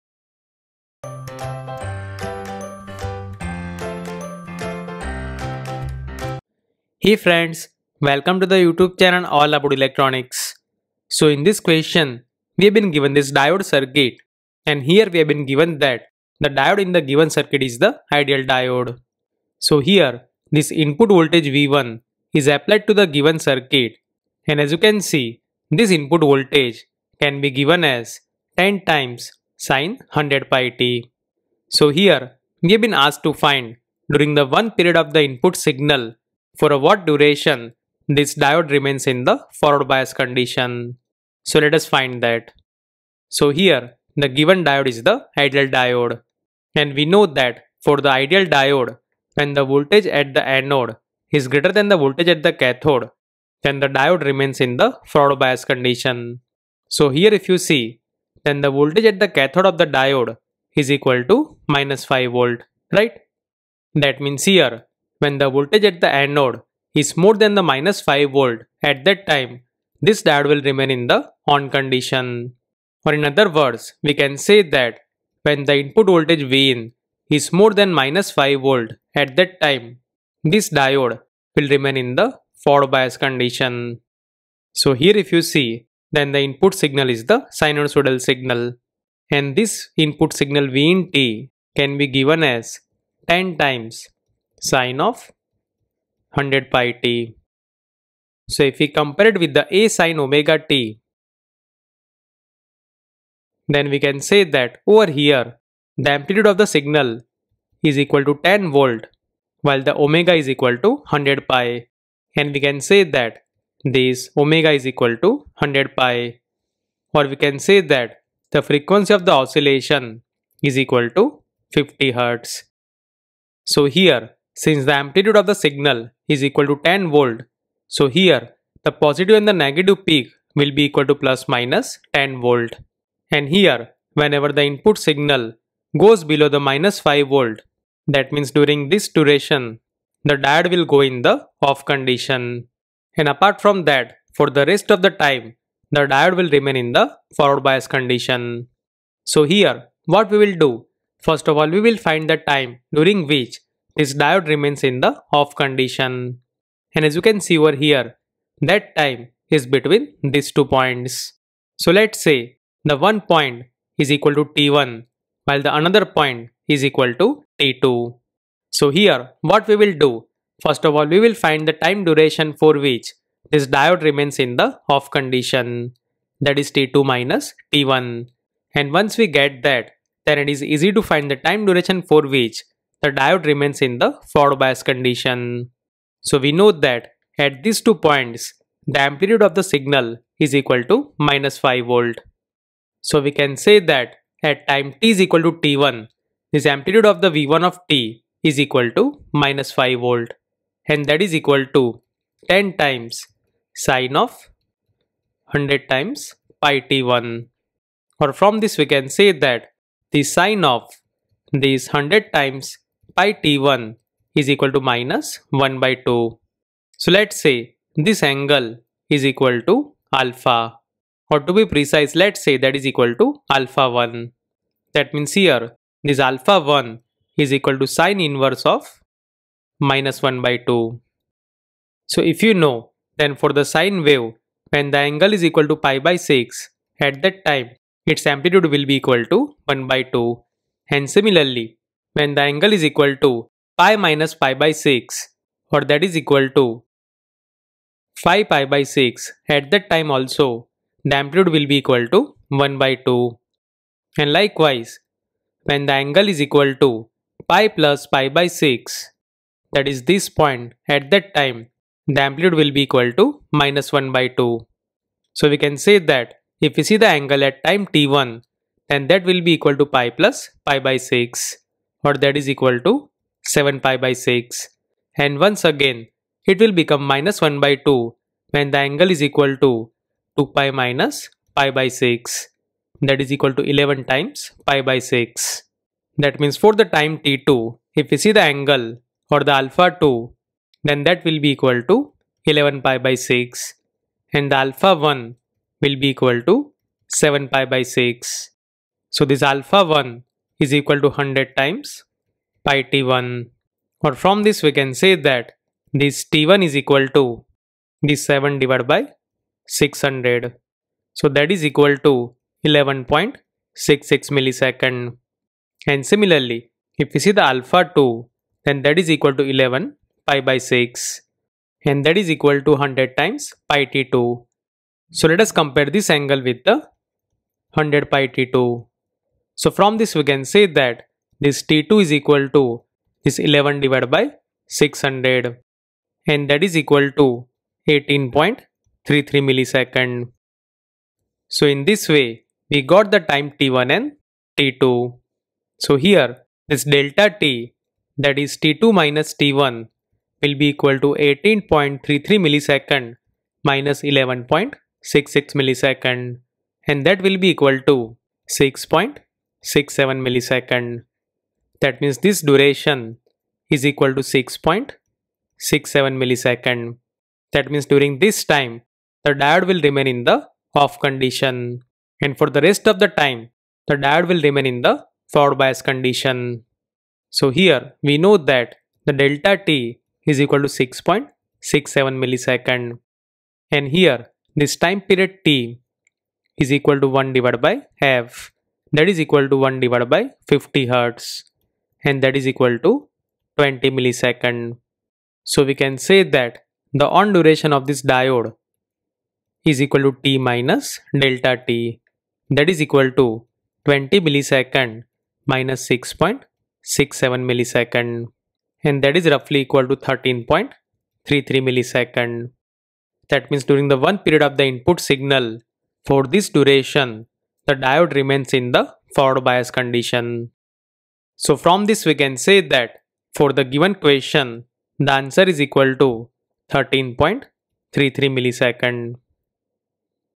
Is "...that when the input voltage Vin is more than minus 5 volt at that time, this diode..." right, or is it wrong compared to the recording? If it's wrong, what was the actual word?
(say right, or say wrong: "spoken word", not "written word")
right.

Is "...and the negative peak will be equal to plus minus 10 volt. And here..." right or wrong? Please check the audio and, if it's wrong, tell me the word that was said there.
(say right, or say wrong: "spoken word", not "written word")
right.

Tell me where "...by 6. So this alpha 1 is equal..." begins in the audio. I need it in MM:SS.
04:57.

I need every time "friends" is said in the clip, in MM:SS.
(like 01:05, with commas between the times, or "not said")
00:07.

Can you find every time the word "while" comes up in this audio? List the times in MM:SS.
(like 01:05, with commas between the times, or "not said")
01:49, 02:45.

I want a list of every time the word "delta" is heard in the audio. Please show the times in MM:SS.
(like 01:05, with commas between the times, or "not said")
05:46, 06:19, 06:41.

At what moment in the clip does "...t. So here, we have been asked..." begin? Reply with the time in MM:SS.
00:30.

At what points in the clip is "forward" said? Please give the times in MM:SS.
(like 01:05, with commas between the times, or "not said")
00:39, 00:55, 01:22, 02:27, 03:04, 06:15, 06:59.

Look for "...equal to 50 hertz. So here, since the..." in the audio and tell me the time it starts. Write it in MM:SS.
02:00.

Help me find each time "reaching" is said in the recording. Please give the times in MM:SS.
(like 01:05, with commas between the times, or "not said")
not said.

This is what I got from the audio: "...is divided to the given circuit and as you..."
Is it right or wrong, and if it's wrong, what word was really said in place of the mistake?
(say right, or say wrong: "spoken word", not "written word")
wrong: "applied", not "divided".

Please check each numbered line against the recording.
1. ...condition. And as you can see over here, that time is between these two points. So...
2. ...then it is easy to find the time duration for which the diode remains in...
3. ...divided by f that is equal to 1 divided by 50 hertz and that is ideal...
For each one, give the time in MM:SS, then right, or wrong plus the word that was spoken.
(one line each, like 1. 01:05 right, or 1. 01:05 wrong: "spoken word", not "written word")
1. 02:35 right
2. 03:00 right
3. 06:27 wrong: "equal", not "ideal".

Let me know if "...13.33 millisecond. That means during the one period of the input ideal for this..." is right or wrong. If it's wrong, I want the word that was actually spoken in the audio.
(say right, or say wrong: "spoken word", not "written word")
wrong: "signal", not "ideal".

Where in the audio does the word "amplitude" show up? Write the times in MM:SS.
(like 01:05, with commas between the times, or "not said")
01:46, 02:04, 03:09, 03:16, 03:58, 04:11, 04:22.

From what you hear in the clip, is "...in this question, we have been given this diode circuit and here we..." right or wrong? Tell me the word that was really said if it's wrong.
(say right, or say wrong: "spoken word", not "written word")
right.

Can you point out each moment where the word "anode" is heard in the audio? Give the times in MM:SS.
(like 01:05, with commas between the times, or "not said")
00:50, 01:06.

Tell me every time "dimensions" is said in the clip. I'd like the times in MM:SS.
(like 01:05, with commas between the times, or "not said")
not said.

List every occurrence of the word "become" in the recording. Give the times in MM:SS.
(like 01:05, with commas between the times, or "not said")
04:36.